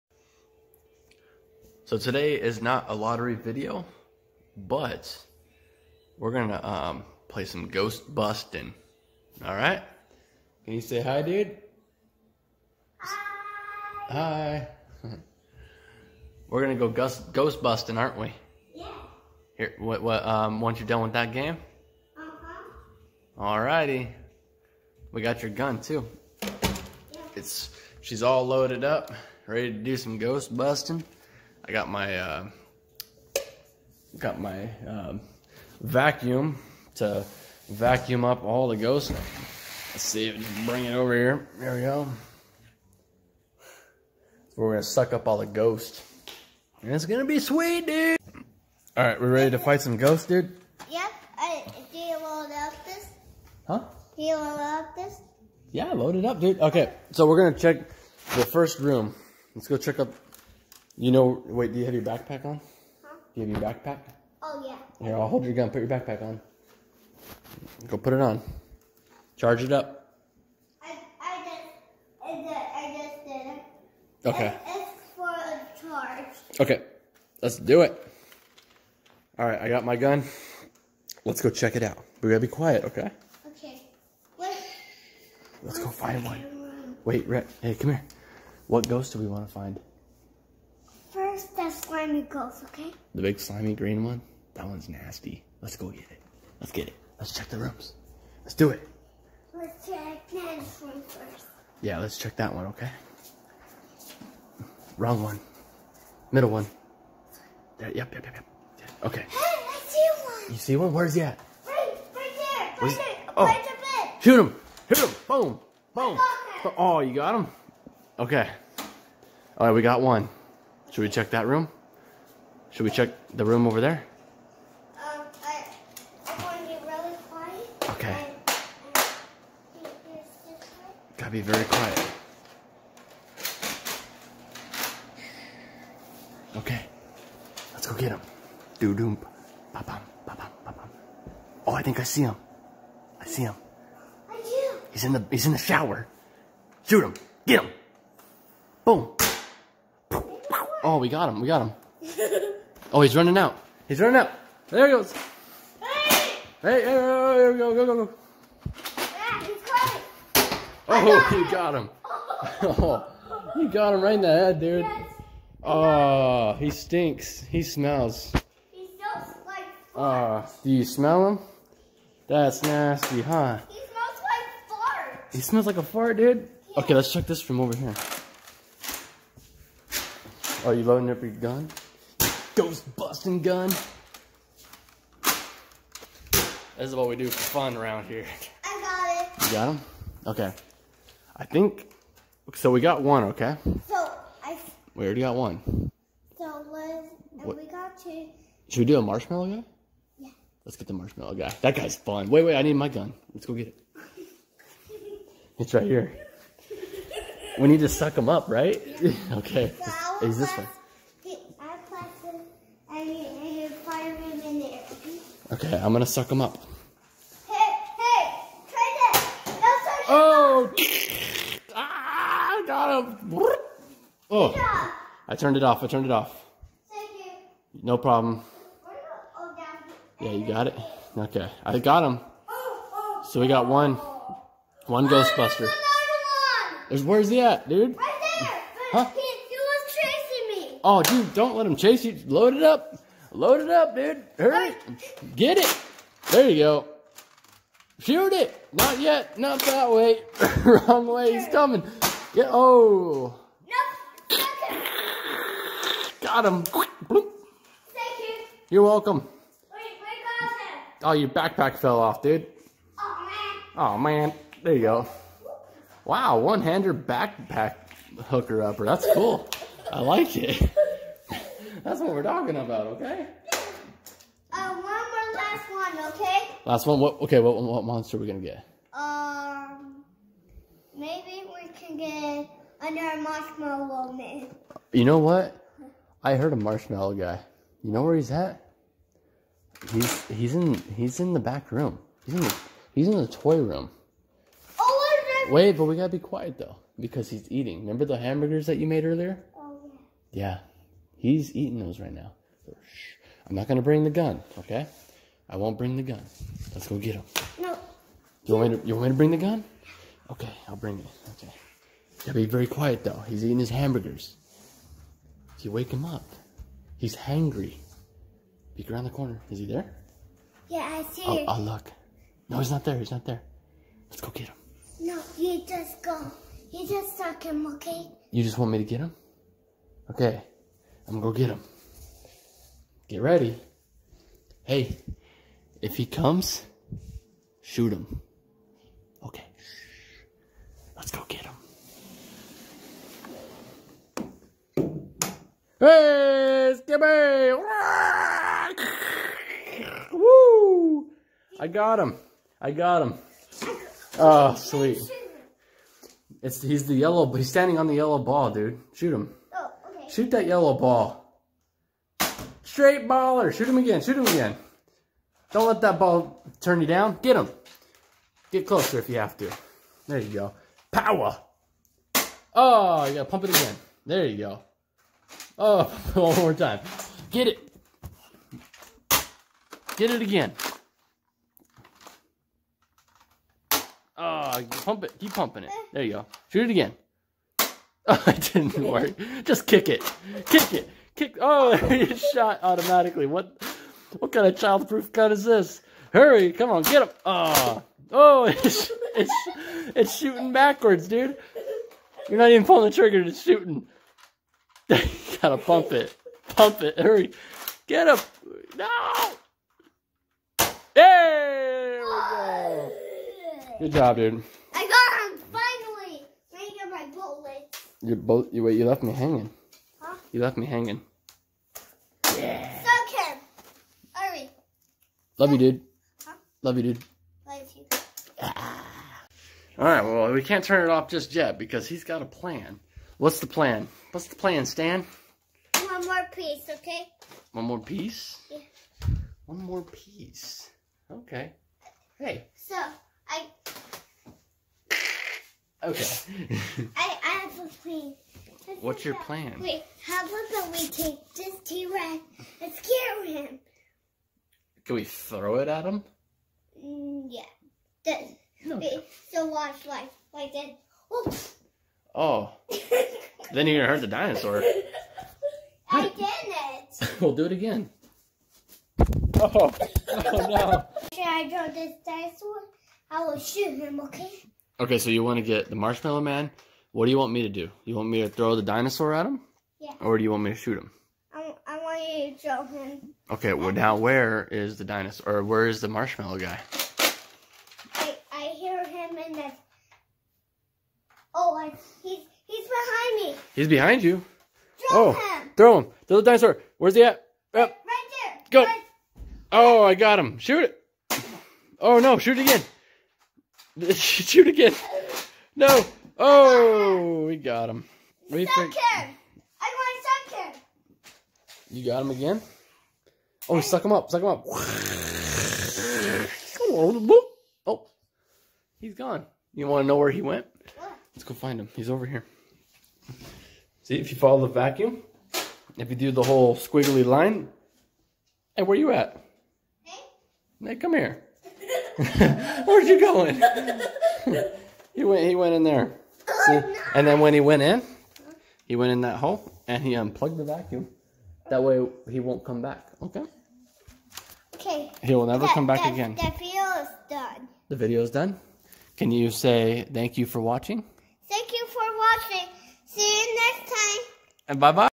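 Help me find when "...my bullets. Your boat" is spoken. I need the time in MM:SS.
06:56.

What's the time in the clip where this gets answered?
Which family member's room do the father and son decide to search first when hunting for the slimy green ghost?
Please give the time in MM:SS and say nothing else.
01:40.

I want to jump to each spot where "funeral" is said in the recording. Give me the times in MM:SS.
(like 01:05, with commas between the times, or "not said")
not said.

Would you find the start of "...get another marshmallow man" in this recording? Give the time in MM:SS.
04:41.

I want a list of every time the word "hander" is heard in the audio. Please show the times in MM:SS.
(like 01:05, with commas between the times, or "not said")
04:26.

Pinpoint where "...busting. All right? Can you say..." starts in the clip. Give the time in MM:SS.
00:08.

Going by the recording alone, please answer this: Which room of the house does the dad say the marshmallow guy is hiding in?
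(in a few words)
Toy room.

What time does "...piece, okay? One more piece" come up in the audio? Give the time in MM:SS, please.
07:16.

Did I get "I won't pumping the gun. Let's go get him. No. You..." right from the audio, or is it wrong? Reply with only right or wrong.
wrong.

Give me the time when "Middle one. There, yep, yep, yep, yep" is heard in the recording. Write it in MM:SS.
01:46.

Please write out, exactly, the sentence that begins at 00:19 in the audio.
Here, what, what, um, once you're done with that game?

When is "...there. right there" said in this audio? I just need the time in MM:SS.
01:52.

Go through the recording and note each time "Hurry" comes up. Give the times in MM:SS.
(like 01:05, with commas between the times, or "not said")
04:04, 06:36, 06:46, 07:04.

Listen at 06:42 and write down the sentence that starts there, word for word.
You're not even pulling the trigger.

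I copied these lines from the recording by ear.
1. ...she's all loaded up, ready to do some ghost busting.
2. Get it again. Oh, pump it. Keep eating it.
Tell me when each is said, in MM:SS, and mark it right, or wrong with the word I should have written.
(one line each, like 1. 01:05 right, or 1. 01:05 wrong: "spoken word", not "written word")
1. 00:27 right
2. 06:19 wrong: "pumping", not "eating".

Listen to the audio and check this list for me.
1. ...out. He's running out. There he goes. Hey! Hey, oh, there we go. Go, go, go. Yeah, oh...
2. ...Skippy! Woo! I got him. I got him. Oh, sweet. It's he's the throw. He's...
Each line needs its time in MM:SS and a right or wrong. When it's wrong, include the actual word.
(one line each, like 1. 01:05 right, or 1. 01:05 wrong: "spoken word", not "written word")
1. 02:33 right
2. 05:46 wrong: "yellow", not "throw".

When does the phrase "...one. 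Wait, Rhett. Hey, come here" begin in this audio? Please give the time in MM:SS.
01:26.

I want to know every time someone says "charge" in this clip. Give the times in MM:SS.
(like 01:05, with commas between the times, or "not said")
01:09, 01:15.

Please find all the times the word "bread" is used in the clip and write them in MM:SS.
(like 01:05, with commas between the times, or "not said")
not said.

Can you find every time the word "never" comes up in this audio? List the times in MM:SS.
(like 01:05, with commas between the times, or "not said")
09:05.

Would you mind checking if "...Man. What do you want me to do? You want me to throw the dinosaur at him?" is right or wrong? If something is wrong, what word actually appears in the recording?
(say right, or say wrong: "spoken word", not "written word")
right.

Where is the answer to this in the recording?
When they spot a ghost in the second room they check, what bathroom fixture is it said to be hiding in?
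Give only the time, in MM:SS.
02:25.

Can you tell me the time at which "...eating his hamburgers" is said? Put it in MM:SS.
05:13.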